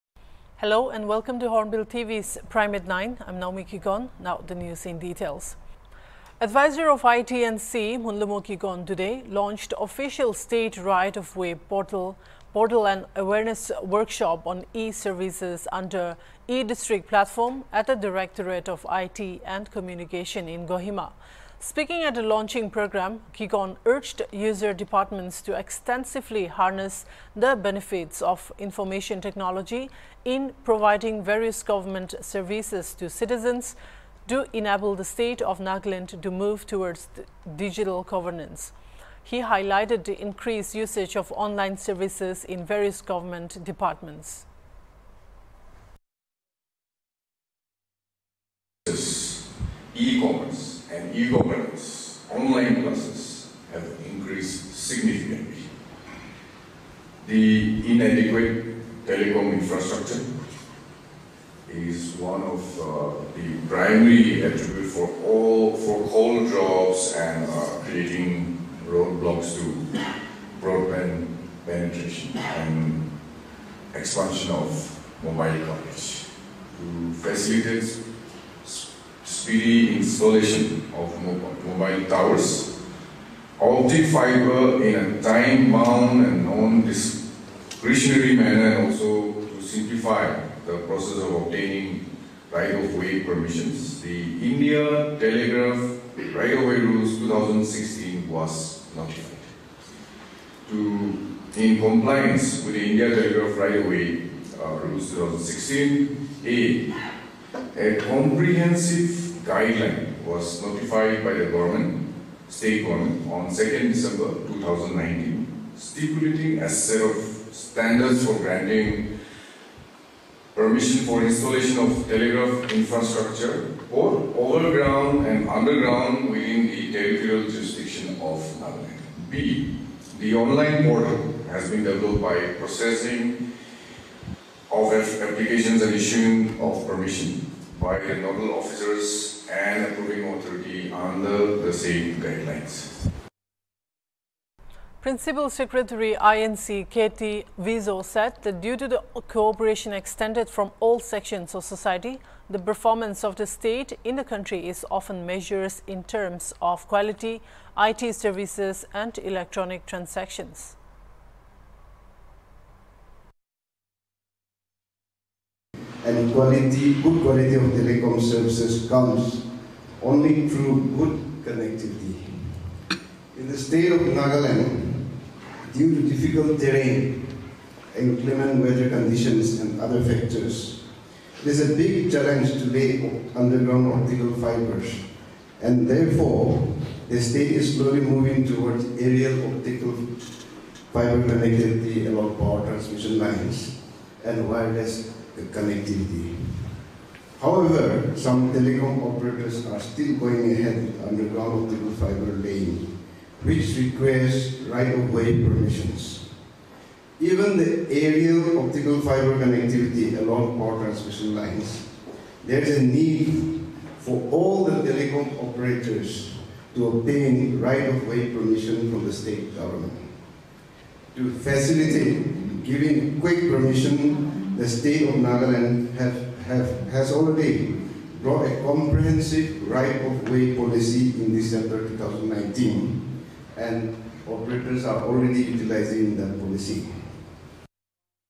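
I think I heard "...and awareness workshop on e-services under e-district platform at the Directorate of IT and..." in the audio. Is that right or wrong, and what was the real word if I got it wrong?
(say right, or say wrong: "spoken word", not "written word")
right.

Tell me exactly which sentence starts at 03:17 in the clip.
However, some telecom operators are still going ahead with underground optical fiber laying, which requires right-of-way permissions.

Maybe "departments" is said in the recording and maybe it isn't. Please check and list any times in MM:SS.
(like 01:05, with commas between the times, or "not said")
00:24, 00:43.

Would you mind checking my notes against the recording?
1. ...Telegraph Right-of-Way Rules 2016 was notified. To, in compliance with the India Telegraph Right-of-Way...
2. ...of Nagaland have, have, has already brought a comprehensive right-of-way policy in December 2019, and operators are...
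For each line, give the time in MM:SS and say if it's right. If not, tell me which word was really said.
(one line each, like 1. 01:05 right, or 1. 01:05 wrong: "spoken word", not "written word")
1. 01:35 right
2. 03:45 right.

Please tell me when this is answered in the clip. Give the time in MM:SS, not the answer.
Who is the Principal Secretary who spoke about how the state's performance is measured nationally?
02:26.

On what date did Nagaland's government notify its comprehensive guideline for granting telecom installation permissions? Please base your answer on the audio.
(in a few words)
2nd December 2019.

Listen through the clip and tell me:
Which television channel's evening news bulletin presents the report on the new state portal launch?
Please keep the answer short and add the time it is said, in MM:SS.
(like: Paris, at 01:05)
Hornbill TV, at 00:01.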